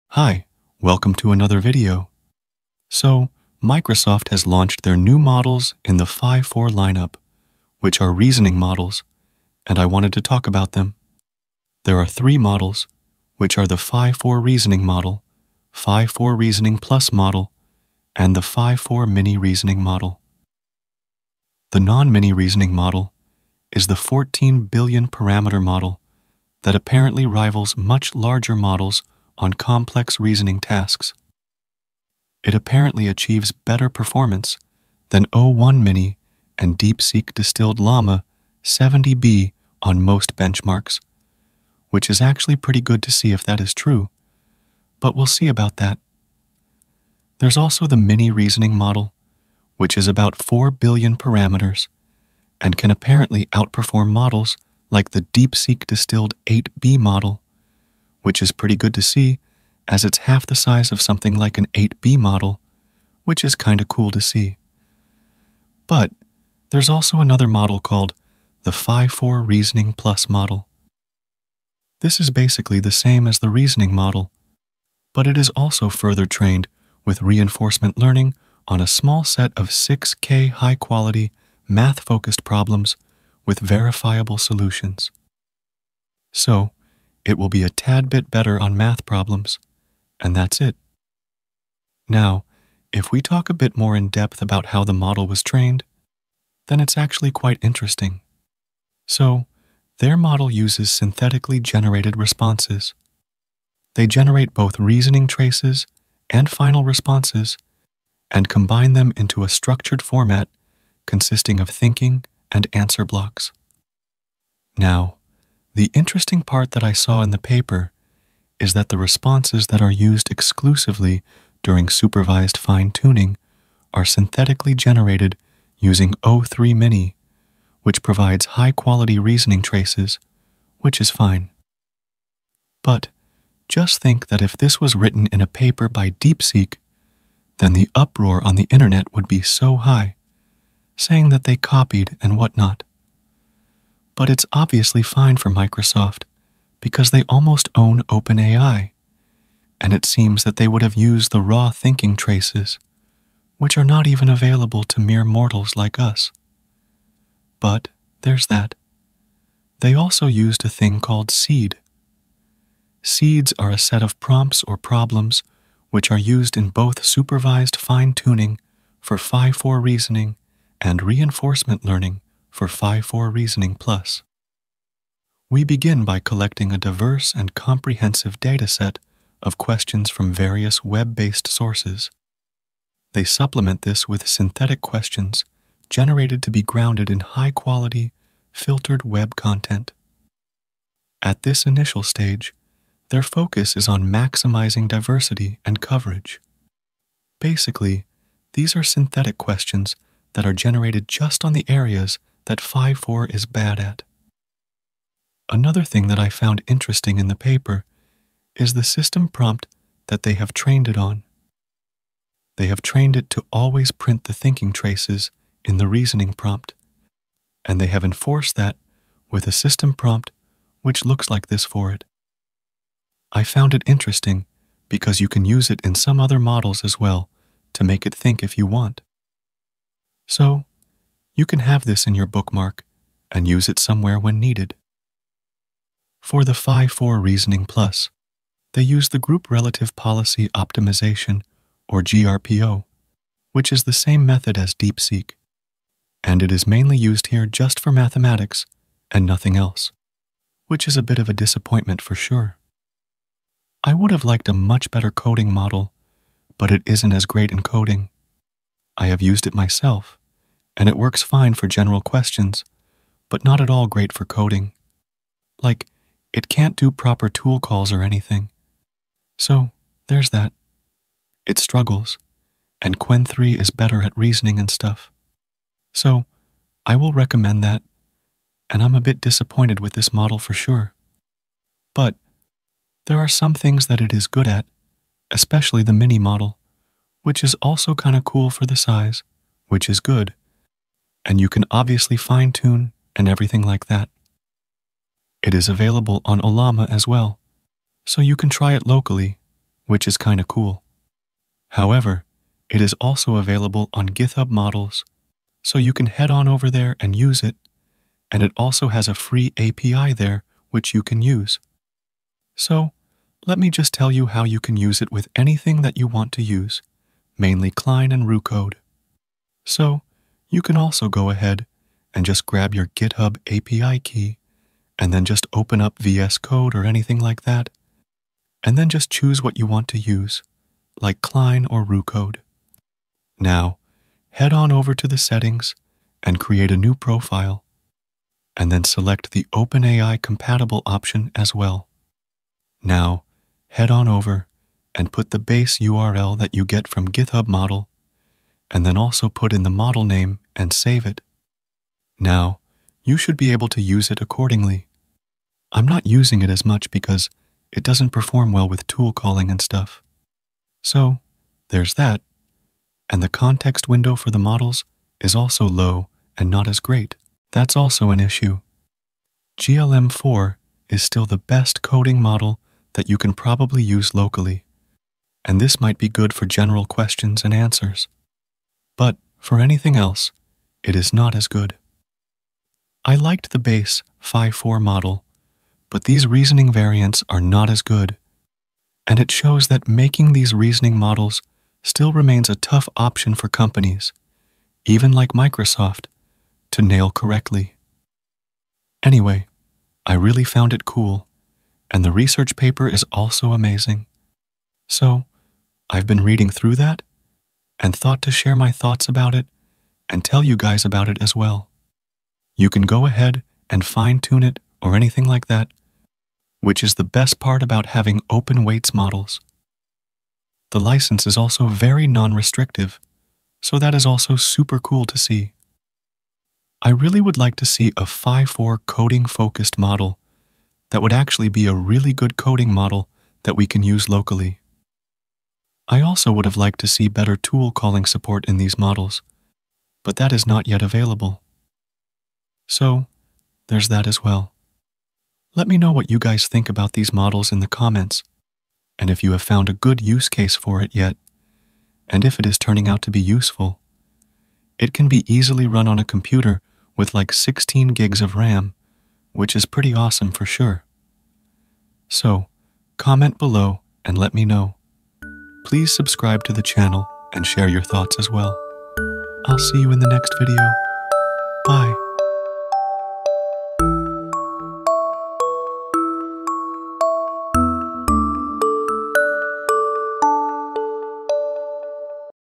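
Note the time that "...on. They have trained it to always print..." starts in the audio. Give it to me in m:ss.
3:30.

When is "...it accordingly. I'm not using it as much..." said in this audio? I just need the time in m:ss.
5:54.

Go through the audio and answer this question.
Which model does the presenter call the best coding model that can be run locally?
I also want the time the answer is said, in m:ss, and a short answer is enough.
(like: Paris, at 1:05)
GLM4, at 6:09.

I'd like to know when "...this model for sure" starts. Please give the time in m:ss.
4:39.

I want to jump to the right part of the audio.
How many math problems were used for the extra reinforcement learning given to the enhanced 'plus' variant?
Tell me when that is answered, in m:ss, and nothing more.
1:19.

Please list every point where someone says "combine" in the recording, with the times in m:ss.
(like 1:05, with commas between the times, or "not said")
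1:48.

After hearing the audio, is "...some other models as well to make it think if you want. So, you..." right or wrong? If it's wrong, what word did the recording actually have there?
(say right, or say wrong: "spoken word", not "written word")
right.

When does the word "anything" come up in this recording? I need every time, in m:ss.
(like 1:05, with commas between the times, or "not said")
4:28, 5:15, 5:26, 6:19, 6:54.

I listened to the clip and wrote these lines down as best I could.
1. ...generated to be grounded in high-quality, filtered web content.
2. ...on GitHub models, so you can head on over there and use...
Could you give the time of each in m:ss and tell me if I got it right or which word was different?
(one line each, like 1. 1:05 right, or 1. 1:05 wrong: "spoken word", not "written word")
1. 3:05 right
2. 5:03 right.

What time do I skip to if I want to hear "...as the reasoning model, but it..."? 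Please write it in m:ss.
1:13.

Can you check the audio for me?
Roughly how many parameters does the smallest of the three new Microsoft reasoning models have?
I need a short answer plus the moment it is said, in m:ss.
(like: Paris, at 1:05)
4 billion, at 0:50.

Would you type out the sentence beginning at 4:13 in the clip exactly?
I would have liked a much better coding model, but it isn't as great in coding.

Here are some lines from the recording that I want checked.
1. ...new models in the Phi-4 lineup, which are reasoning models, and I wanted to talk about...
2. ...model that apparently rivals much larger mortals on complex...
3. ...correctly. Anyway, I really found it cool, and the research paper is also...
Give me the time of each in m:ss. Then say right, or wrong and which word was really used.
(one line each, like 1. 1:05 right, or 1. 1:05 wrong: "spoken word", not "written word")
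1. 0:04 right
2. 0:25 wrong: "models", not "mortals"
3. 6:37 right.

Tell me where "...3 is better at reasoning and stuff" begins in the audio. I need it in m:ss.
4:33.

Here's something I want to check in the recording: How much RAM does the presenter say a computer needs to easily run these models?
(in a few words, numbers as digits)
16 gigs.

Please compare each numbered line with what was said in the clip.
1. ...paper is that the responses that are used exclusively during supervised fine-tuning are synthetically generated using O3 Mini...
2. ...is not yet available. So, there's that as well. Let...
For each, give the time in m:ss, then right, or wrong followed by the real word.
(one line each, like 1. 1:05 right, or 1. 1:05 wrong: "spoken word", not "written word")
1. 1:57 right
2. 7:20 right.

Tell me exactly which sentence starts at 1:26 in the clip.
So, it will be a tad bit better on math problems, and that's it.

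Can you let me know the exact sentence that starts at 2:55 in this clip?
We begin by collecting a diverse and comprehensive dataset of questions from various web-based sources.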